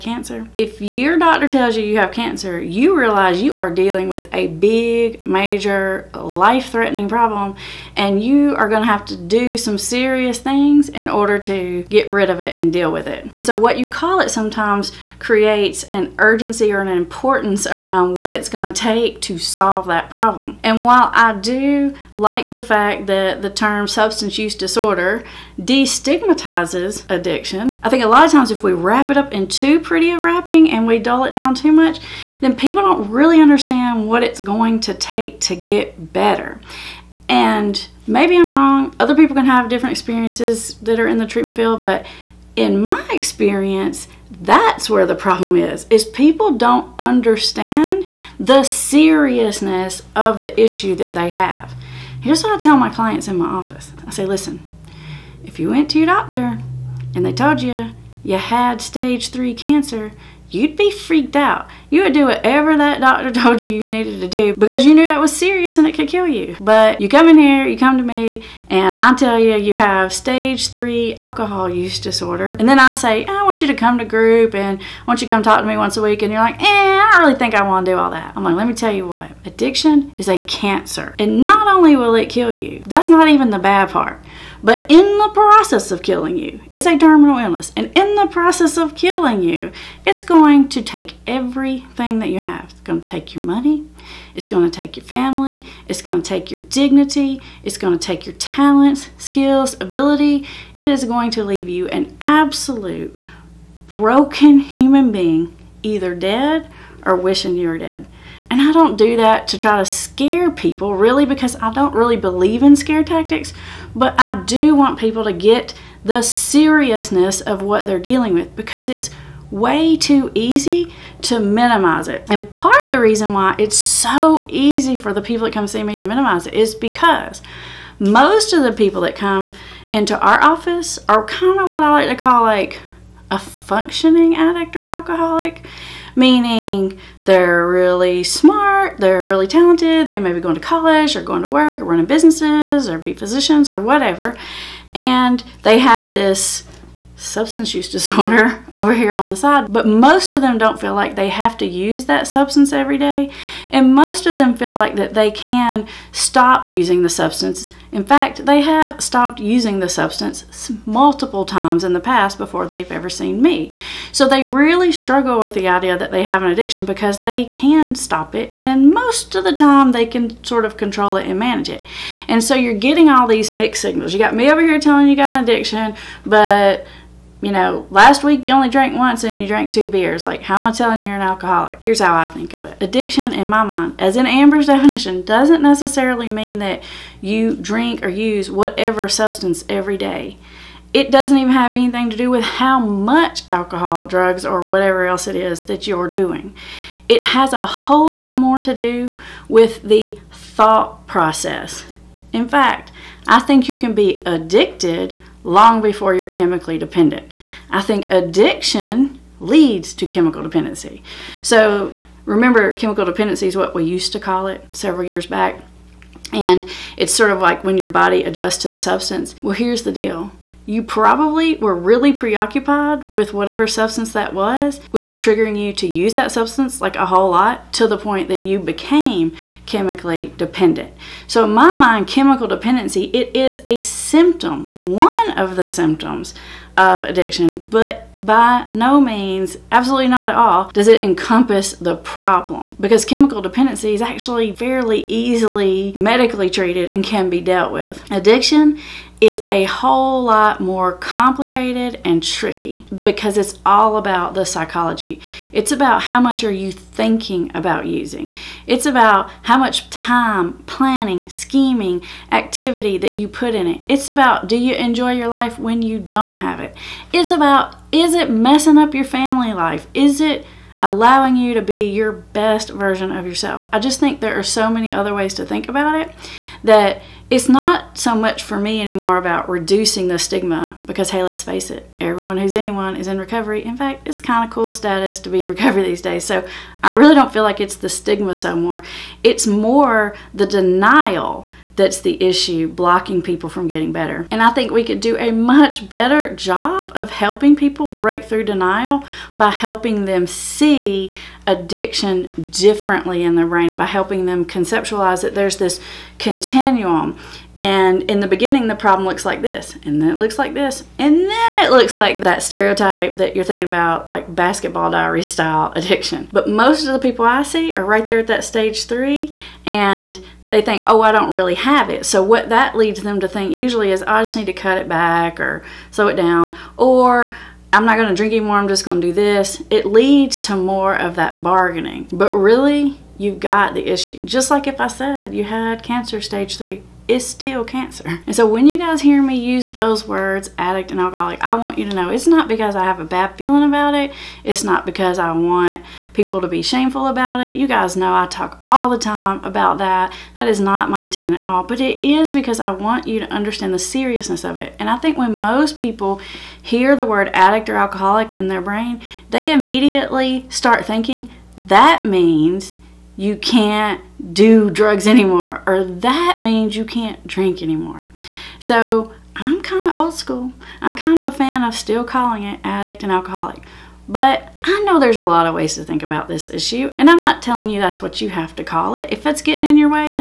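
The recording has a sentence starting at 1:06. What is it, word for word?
But you come in here, you come to me, and I tell you, you have stage three alcohol use disorder.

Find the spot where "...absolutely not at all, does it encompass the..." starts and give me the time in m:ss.
3:59.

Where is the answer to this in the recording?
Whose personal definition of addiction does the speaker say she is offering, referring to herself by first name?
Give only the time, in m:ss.
3:04.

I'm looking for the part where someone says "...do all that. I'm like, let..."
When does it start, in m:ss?
1:17.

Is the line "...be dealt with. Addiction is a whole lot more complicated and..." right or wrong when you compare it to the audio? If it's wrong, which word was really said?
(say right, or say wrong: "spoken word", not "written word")
right.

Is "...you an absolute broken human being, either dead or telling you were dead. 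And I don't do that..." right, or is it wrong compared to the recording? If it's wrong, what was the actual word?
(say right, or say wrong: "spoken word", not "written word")
wrong: "wishing", not "telling".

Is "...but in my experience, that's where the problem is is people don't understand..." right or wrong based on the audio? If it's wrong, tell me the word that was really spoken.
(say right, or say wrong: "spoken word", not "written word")
right.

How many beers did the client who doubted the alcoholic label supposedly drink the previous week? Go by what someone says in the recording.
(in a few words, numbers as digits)
2.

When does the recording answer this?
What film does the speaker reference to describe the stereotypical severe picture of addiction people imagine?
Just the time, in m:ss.
5:14.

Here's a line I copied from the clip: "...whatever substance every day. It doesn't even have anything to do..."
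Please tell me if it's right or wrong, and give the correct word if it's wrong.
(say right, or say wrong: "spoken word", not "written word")
right.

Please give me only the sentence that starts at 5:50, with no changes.
That is not my intent at all, but it is because I want you to understand the seriousness of it.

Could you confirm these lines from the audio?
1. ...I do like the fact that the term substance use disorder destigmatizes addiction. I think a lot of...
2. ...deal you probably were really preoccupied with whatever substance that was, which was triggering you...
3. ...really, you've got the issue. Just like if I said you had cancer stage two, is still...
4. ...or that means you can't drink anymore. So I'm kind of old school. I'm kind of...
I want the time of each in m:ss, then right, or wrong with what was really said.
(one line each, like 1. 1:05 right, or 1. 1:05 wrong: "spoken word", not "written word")
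1. 0:21 right
2. 3:39 right
3. 5:32 wrong: "three", not "two"
4. 6:05 right.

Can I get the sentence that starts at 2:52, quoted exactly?
And so you're getting all these mixed signals.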